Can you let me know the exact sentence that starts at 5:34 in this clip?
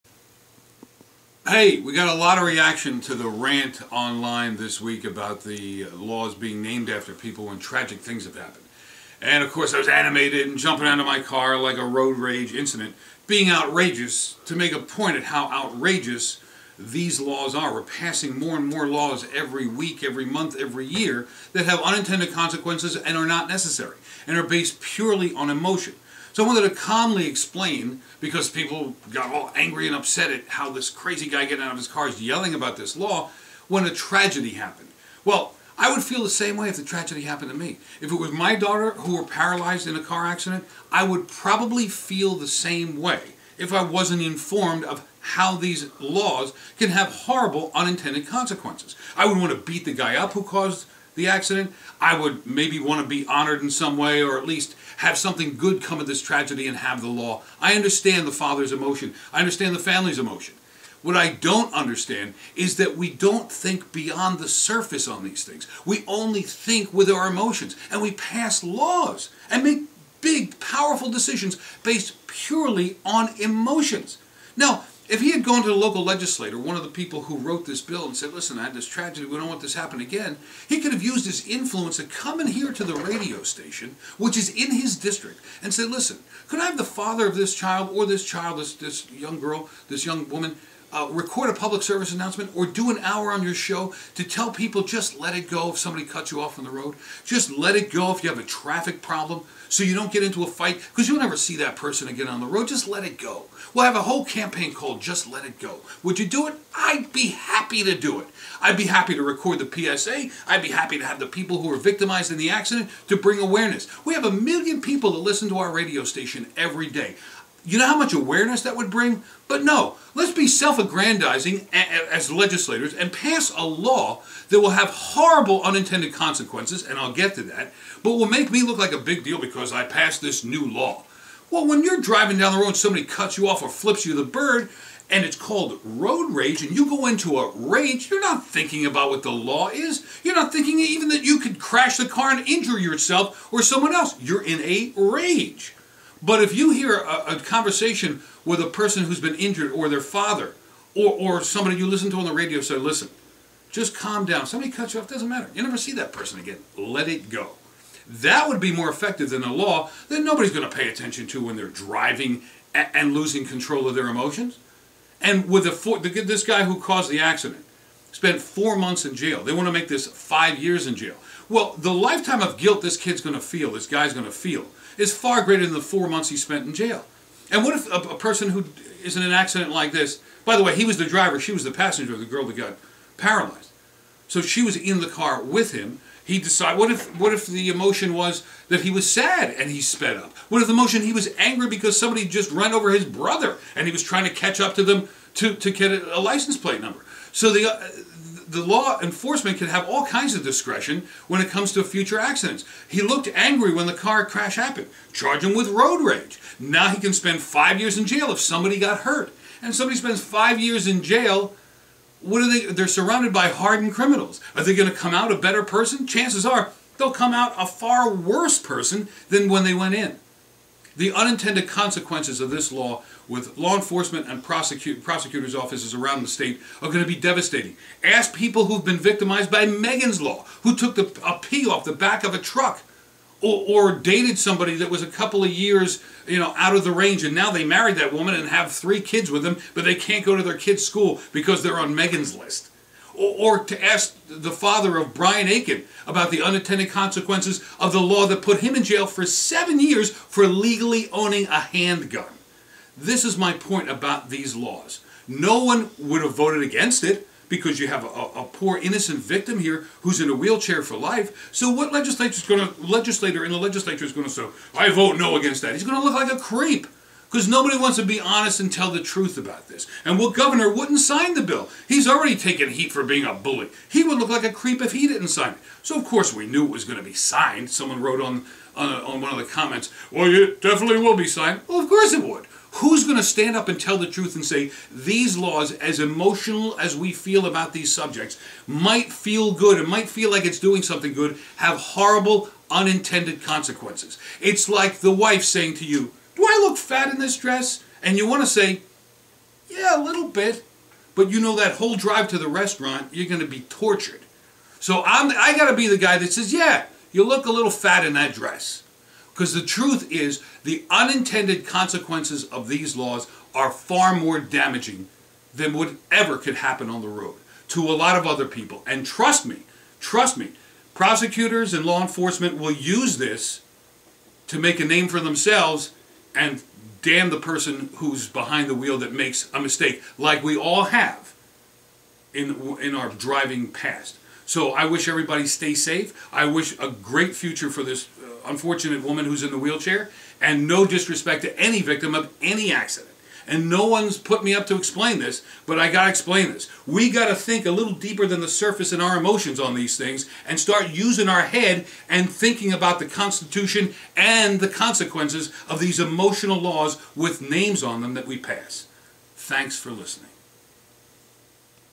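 So I wish everybody stay safe.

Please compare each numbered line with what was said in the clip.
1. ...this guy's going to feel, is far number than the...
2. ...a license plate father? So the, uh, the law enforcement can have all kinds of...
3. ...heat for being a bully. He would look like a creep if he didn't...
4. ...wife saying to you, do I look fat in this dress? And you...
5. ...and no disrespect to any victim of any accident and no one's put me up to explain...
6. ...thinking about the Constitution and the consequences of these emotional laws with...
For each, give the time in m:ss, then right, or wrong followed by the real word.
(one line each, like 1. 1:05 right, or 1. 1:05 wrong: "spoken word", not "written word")
1. 2:53 wrong: "greater", not "number"
2. 3:15 wrong: "number", not "father"
3. 4:32 right
4. 4:55 right
5. 5:40 right
6. 5:52 right.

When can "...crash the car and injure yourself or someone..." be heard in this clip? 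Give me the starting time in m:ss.
2:21.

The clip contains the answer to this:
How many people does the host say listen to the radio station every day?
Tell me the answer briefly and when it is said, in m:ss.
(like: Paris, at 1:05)
1000000, at 1:54.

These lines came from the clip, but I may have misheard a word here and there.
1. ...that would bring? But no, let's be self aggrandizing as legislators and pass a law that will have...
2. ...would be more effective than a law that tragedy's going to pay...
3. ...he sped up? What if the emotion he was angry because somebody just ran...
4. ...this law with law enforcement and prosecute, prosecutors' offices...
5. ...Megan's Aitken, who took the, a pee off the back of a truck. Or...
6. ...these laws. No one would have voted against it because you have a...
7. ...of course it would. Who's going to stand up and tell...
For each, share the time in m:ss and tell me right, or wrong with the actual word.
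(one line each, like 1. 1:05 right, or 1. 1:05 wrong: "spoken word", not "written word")
1. 1:58 right
2. 2:38 wrong: "nobody", not "tragedy"
3. 3:09 right
4. 3:42 right
5. 3:49 wrong: "Law", not "Aitken"
6. 4:14 right
7. 4:41 right.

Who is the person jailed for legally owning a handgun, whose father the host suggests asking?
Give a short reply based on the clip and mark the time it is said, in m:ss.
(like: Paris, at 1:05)
Brian Aitken, at 4:05.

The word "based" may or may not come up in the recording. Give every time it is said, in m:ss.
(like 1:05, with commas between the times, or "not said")
0:24, 1:11.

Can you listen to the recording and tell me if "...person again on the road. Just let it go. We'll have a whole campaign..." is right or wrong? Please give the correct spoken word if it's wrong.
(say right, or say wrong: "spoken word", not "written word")
right.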